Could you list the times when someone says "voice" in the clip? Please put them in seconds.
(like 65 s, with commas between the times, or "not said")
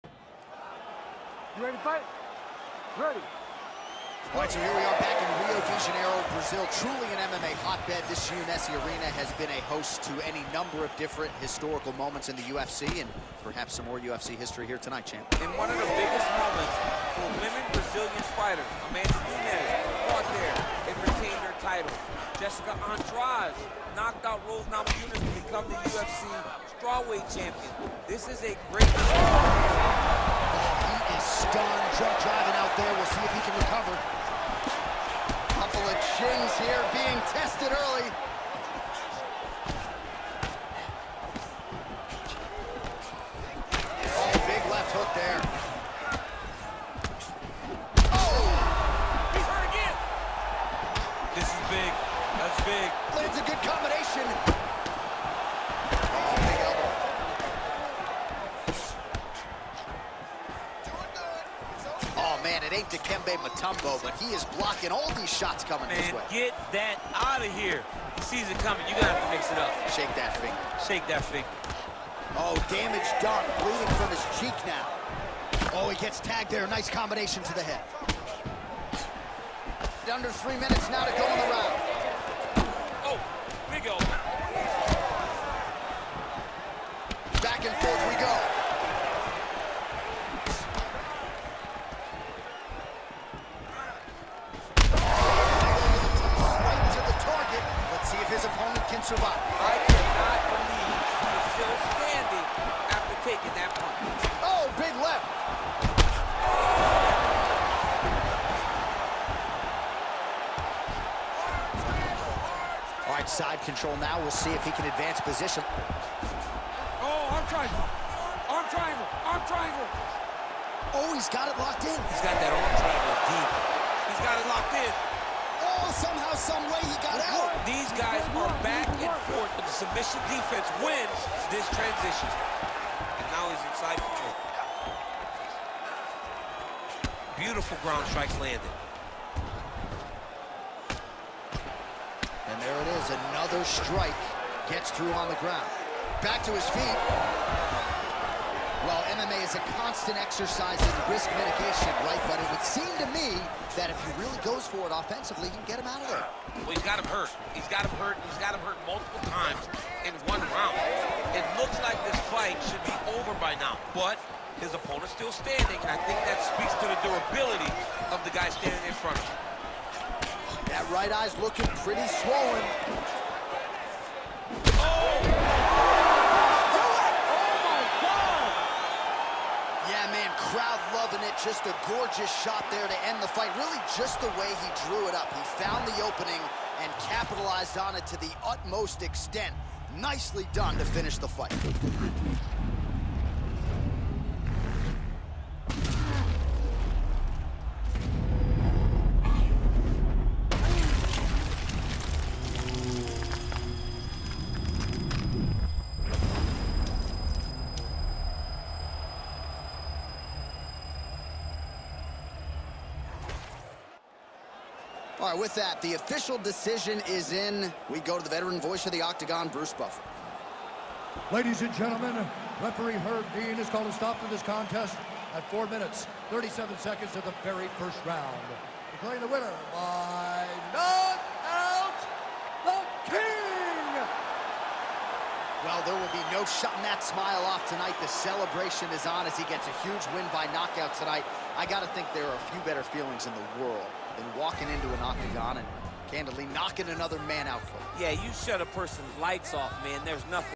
218 s.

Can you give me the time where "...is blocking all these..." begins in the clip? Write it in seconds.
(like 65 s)
64 s.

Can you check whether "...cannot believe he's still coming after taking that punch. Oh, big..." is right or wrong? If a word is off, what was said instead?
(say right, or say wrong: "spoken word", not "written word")
wrong: "standing", not "coming".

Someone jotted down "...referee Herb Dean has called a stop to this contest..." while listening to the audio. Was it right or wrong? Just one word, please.
right.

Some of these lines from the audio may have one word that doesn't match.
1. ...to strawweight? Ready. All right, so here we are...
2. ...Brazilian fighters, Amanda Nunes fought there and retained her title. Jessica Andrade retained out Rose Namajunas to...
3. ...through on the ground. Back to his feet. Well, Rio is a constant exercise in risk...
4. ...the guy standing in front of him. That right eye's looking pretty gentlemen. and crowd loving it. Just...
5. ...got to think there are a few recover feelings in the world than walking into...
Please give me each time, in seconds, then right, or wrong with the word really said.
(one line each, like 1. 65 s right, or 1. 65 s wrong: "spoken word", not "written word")
1. 1 s wrong: "fight", not "strawweight"
2. 17 s wrong: "knocked", not "retained"
3. 144 s wrong: "MMA", not "Rio"
4. 168 s wrong: "swollen", not "gentlemen"
5. 241 s wrong: "better", not "recover".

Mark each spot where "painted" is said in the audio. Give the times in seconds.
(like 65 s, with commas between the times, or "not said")
not said.